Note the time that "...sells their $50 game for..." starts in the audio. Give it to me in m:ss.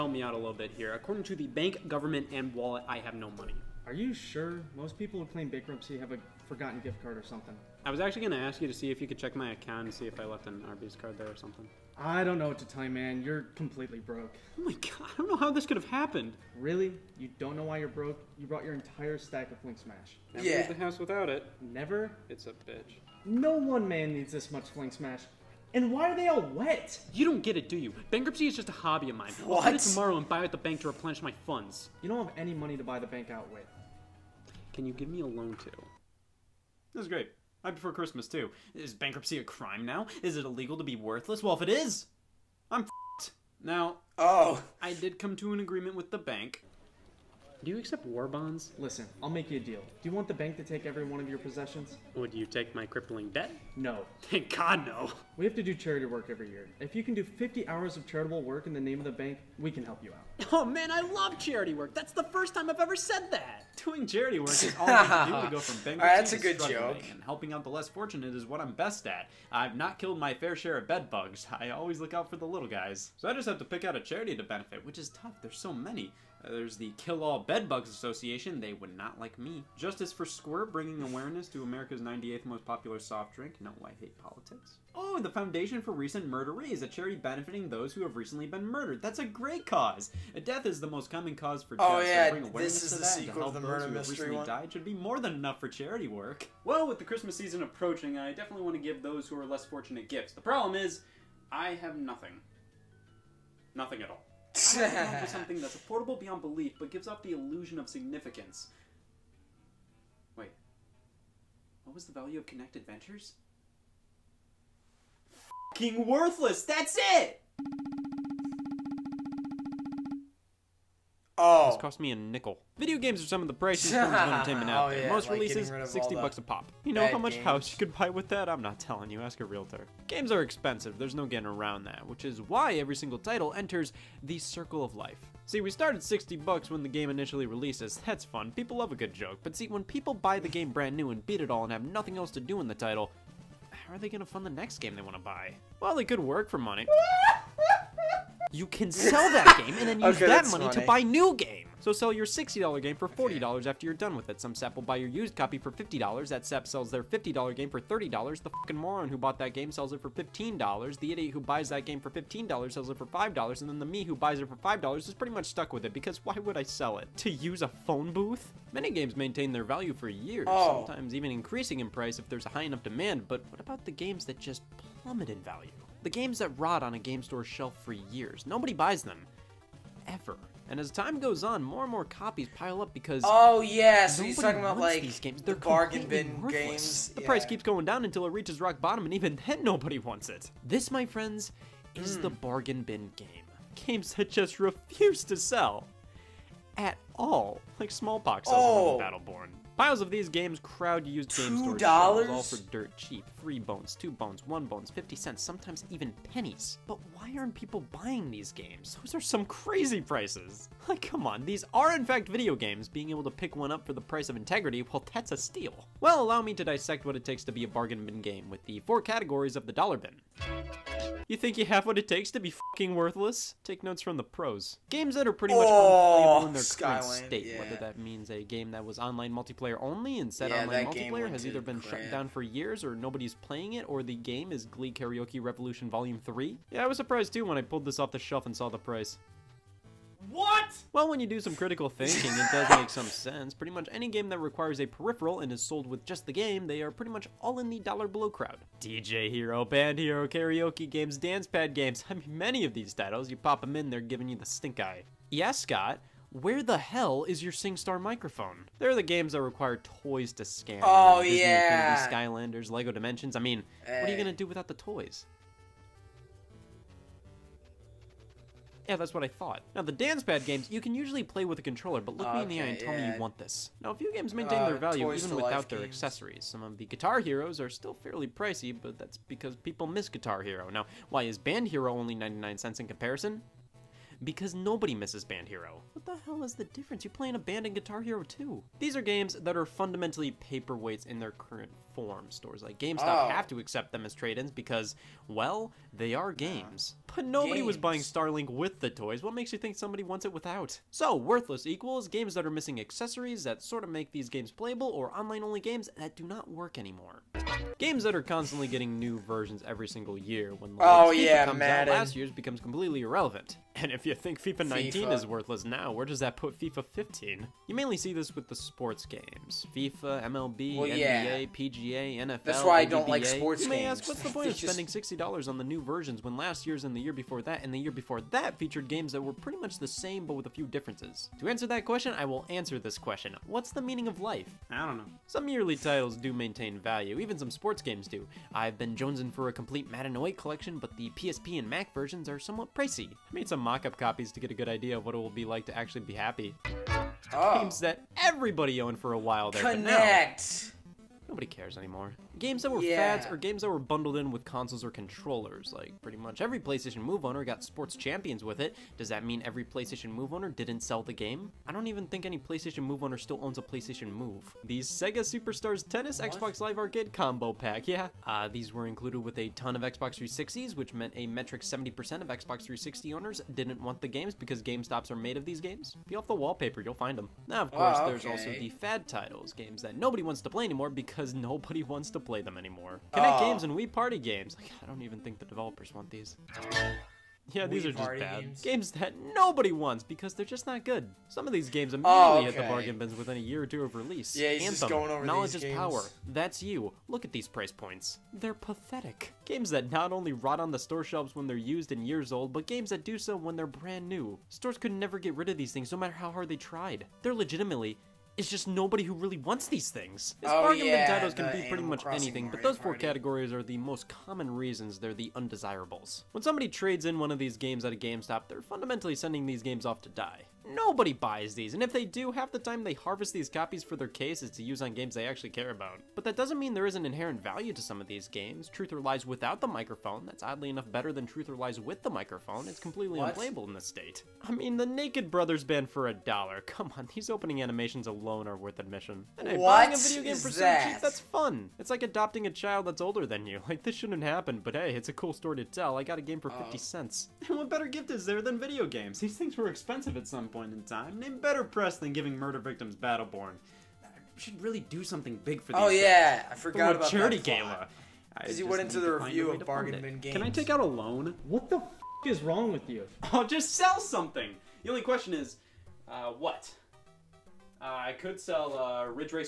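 2:36.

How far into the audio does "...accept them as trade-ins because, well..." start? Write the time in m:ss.
4:53.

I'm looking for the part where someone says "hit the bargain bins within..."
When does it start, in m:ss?
6:32.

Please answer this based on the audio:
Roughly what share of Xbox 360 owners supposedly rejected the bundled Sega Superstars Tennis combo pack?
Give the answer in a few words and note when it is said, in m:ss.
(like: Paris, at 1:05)
70%, at 6:11.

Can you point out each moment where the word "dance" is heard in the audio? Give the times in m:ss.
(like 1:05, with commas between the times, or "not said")
4:11, 4:29.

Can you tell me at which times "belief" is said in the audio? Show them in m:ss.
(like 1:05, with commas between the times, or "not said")
1:46.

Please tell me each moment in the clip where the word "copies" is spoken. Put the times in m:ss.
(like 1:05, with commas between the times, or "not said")
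3:02, 5:43, 7:03.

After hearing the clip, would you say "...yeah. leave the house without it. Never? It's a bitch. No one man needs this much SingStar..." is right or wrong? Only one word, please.
wrong.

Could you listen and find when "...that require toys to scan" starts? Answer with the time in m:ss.
4:19.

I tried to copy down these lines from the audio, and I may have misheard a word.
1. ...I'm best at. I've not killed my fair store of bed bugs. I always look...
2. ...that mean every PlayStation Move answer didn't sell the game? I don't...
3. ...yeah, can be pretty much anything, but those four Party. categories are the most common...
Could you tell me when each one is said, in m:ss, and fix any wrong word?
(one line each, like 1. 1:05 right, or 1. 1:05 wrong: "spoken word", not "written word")
1. 1:08 wrong: "share", not "store"
2. 5:59 wrong: "owner", not "answer"
3. 6:50 right.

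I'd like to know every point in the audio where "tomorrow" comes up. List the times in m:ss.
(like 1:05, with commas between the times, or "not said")
0:29.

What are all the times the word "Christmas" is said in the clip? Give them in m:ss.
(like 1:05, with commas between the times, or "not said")
0:37, 1:37.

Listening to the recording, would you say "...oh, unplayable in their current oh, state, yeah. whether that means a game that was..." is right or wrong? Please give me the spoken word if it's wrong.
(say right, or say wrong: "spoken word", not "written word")
right.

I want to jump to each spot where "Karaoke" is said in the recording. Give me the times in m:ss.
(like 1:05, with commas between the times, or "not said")
3:54, 4:10.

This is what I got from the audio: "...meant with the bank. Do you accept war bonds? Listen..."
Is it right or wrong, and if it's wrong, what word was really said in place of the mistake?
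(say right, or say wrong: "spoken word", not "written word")
wrong: "agreement", not "meant".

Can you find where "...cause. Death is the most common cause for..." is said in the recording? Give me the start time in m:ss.
1:29.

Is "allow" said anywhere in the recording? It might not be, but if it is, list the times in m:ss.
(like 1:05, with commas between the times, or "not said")
3:36.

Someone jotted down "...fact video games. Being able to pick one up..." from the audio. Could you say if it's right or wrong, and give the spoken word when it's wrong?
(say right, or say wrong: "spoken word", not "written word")
right.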